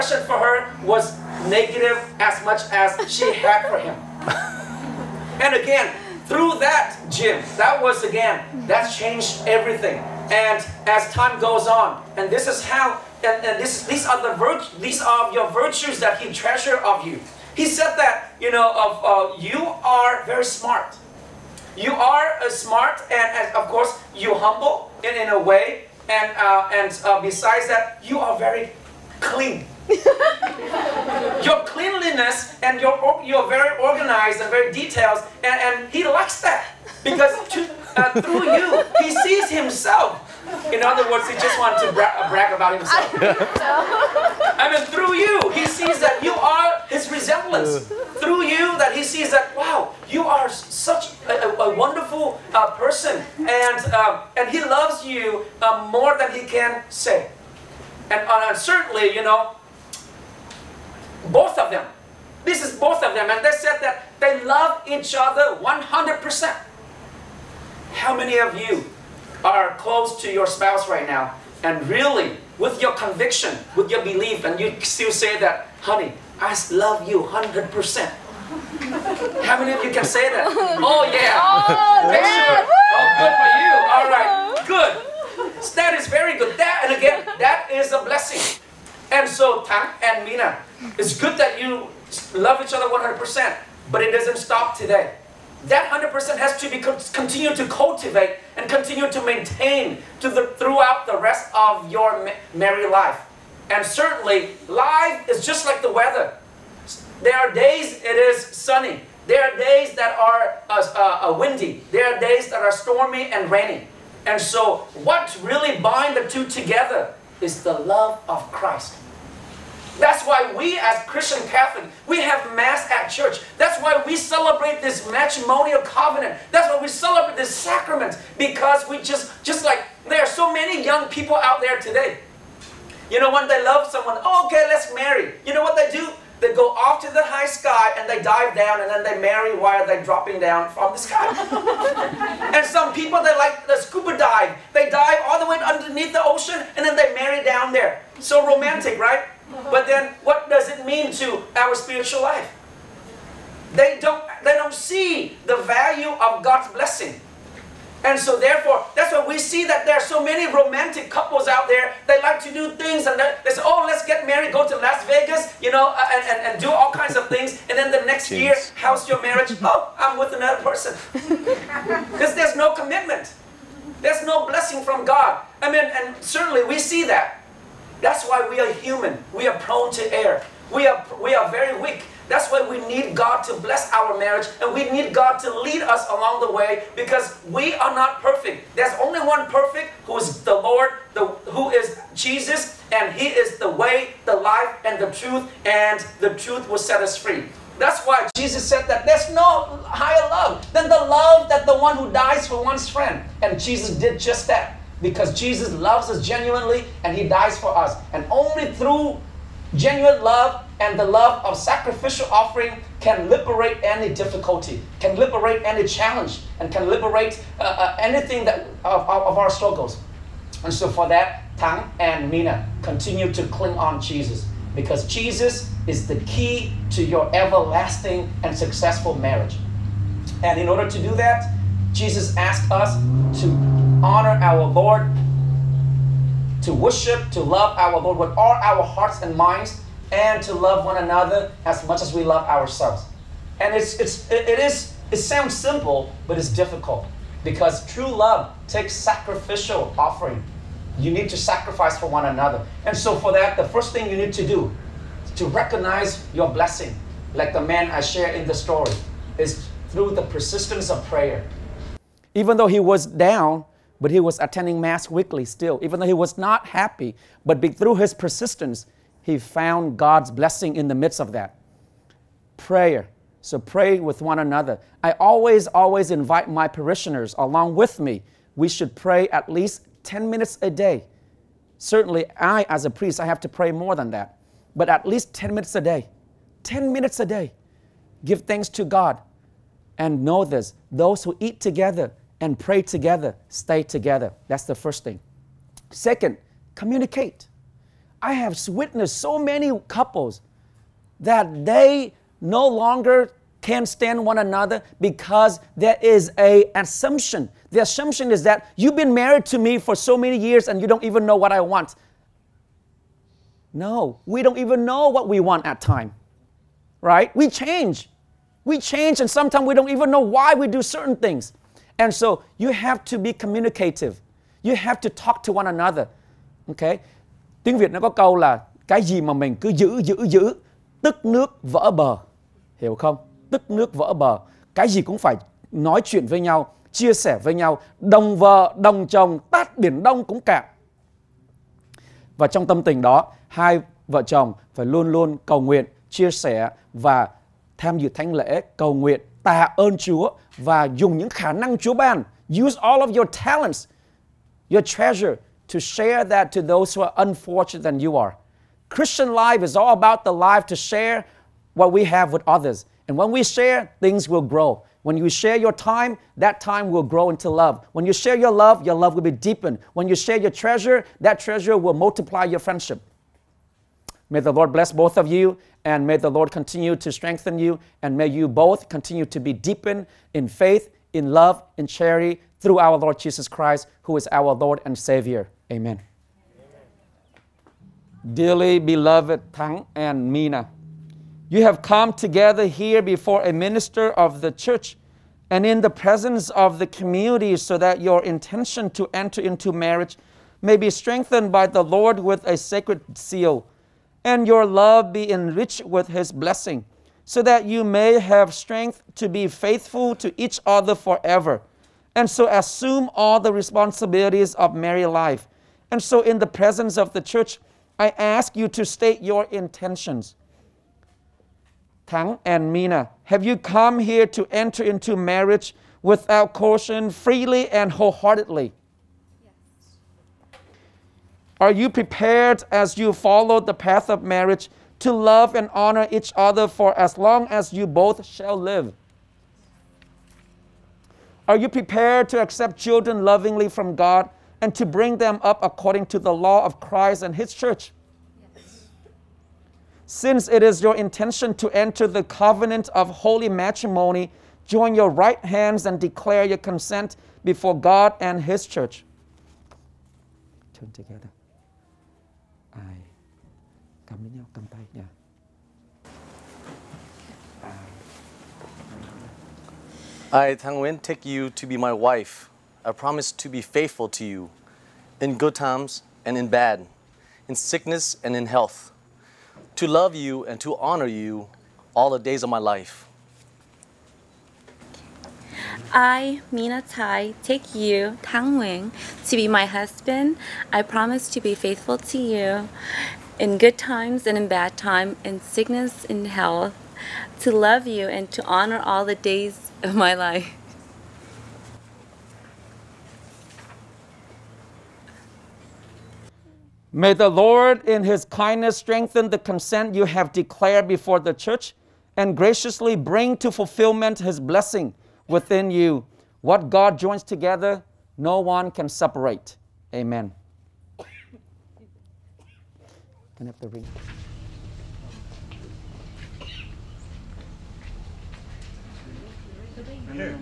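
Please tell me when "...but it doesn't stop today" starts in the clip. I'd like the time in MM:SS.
01:33.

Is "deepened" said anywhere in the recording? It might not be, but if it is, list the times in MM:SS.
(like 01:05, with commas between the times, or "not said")
06:09, 06:19.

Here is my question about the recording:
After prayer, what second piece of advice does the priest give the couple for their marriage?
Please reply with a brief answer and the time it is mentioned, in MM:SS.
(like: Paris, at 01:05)
communicate, at 04:56.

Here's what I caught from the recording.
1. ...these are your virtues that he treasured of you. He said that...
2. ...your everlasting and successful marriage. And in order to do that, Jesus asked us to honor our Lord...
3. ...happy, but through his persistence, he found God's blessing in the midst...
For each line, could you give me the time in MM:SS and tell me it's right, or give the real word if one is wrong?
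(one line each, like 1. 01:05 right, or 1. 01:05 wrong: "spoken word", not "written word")
1. 00:14 right
2. 03:47 right
3. 04:26 right.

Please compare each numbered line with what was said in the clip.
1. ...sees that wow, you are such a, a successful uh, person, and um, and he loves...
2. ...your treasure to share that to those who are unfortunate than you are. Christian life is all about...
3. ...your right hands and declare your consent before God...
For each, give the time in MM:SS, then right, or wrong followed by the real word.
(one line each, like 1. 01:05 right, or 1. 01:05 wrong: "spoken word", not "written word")
1. 00:49 wrong: "wonderful", not "successful"
2. 05:54 right
3. 07:34 right.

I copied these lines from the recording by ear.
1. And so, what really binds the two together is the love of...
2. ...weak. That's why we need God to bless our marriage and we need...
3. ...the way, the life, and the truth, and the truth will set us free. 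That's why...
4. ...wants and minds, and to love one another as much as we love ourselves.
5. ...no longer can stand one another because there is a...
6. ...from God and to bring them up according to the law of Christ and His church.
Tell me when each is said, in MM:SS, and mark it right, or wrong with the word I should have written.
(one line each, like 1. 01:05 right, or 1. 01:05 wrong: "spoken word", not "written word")
1. 01:54 right
2. 03:01 right
3. 03:13 right
4. 03:58 wrong: "hearts", not "wants"
5. 05:02 right
6. 07:23 right.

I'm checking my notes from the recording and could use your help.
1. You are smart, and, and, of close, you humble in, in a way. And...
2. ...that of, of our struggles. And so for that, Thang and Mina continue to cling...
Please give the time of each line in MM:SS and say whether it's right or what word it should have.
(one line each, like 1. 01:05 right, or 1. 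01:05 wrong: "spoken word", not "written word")
1. 00:21 wrong: "course", not "close"
2. 03:38 right.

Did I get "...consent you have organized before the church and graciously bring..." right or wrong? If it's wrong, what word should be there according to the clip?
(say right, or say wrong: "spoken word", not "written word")
wrong: "declared", not "organized".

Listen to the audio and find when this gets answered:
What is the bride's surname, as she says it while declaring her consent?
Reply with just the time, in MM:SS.
08:06.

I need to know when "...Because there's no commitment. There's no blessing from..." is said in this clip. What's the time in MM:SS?
02:52.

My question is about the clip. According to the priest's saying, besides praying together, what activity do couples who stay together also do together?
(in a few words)
eat.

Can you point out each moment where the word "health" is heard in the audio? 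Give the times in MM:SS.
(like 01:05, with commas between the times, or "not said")
07:58, 08:16.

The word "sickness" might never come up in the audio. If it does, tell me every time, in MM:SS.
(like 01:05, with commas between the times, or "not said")
07:57, 08:15.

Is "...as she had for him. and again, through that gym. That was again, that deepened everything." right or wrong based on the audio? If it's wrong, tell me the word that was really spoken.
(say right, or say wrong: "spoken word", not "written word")
wrong: "changed", not "deepened".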